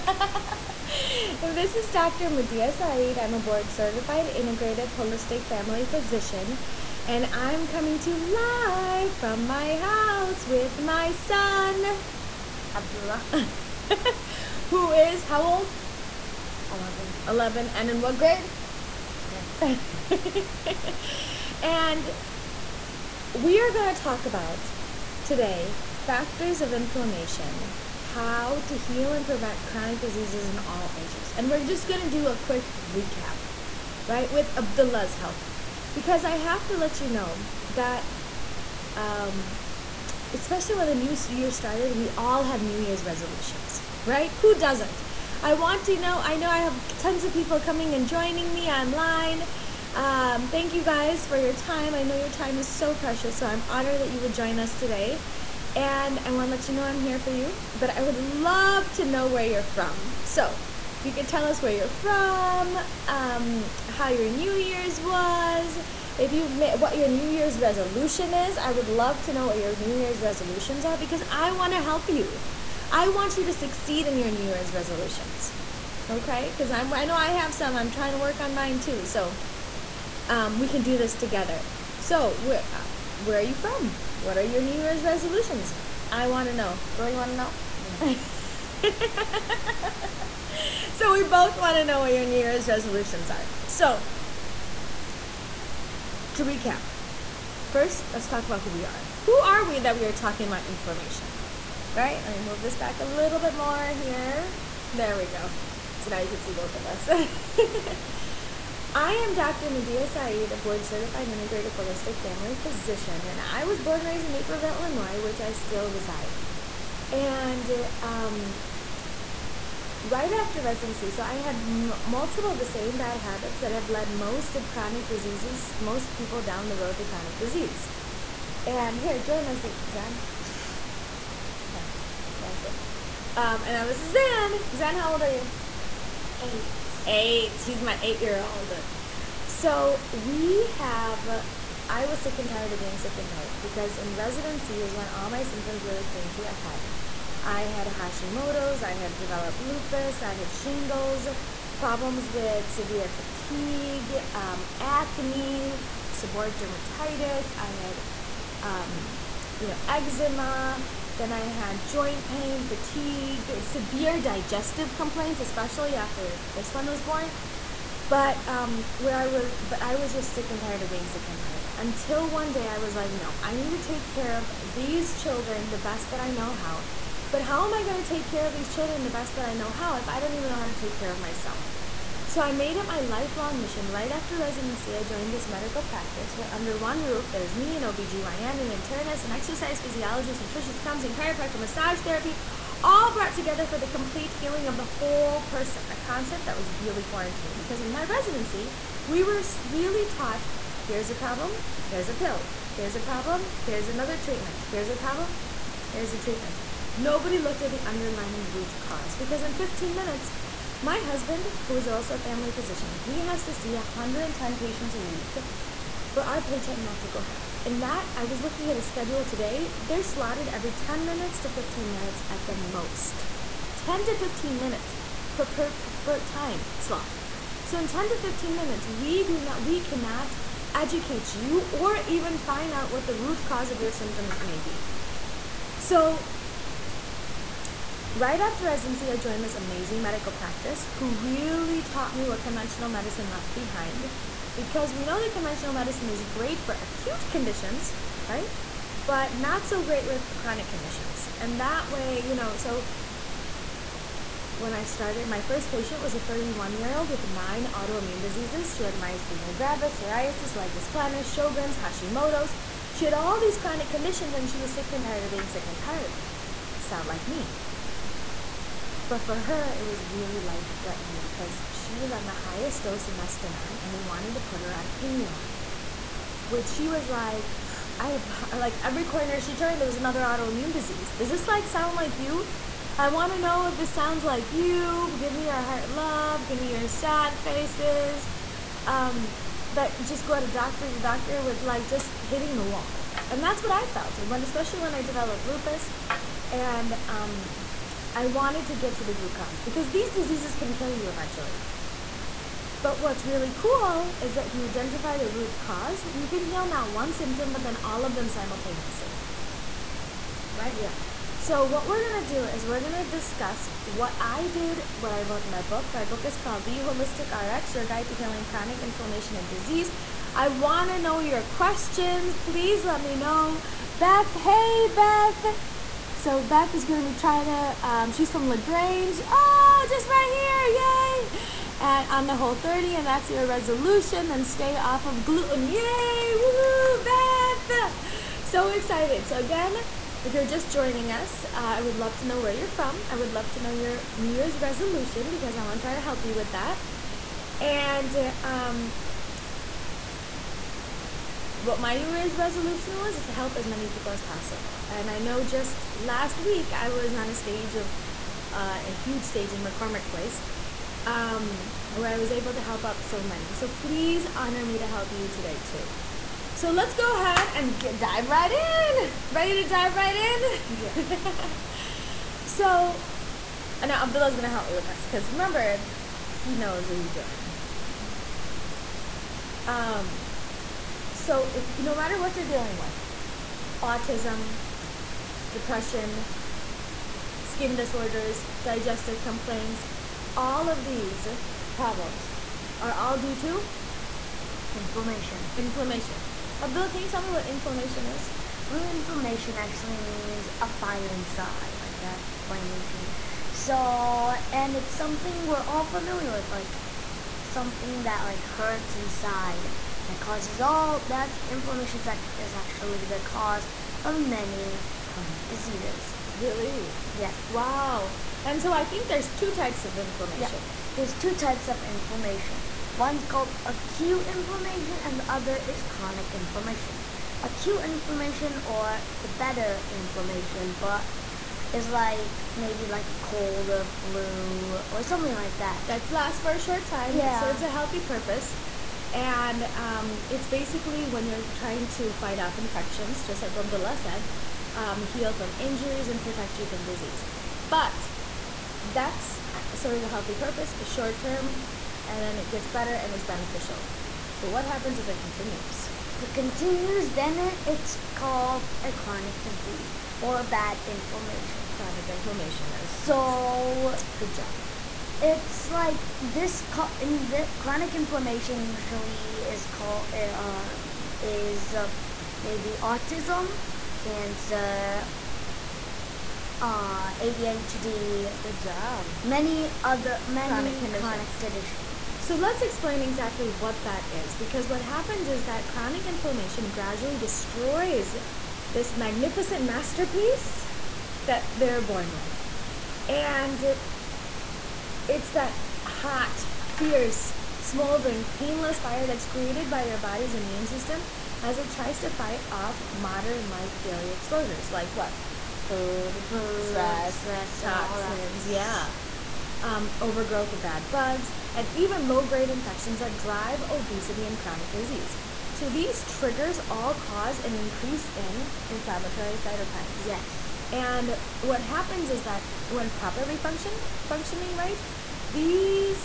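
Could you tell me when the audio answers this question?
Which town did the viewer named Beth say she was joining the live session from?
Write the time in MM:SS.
05:28.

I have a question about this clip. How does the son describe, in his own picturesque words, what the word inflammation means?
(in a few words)
A fire inside.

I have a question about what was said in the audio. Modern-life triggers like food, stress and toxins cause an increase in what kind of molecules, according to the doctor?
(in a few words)
Inflammatory cytokines.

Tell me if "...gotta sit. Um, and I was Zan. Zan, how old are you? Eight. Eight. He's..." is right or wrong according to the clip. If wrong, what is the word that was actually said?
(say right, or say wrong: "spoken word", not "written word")
right.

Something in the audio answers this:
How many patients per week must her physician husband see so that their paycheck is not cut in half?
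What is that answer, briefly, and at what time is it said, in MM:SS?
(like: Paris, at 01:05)
110, at 03:33.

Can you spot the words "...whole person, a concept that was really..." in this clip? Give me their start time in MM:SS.
03:14.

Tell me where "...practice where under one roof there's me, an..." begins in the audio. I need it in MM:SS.
03:05.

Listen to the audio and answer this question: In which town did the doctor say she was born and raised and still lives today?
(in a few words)
Naperville.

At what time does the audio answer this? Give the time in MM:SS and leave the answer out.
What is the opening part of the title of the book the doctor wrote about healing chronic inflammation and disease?
05:16.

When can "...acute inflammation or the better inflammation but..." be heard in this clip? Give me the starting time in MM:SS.
07:07.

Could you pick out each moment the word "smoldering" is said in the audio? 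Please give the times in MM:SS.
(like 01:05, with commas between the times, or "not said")
08:17.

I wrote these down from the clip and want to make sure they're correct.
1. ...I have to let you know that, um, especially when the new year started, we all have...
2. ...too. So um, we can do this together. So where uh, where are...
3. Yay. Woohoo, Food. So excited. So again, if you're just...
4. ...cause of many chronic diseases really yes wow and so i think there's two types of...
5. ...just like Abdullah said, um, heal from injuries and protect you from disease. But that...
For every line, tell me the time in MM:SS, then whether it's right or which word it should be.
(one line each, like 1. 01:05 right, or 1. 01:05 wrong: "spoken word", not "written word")
1. 00:36 right
2. 01:18 right
3. 05:35 wrong: "Beth", not "Food"
4. 06:53 right
5. 07:23 right.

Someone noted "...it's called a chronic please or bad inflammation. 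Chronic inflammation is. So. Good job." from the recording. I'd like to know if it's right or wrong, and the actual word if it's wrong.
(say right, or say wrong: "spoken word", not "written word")
wrong: "disease", not "please".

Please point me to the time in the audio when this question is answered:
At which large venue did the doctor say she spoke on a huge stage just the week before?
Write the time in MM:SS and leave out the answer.
05:59.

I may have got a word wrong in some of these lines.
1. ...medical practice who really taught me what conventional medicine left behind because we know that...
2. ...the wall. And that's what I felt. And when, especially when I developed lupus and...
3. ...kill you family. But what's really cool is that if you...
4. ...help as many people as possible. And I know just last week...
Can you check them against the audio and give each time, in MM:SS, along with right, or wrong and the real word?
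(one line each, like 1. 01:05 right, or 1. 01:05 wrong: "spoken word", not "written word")
1. 04:00 right
2. 04:52 right
3. 05:00 wrong: "eventually", not "family"
4. 05:53 right.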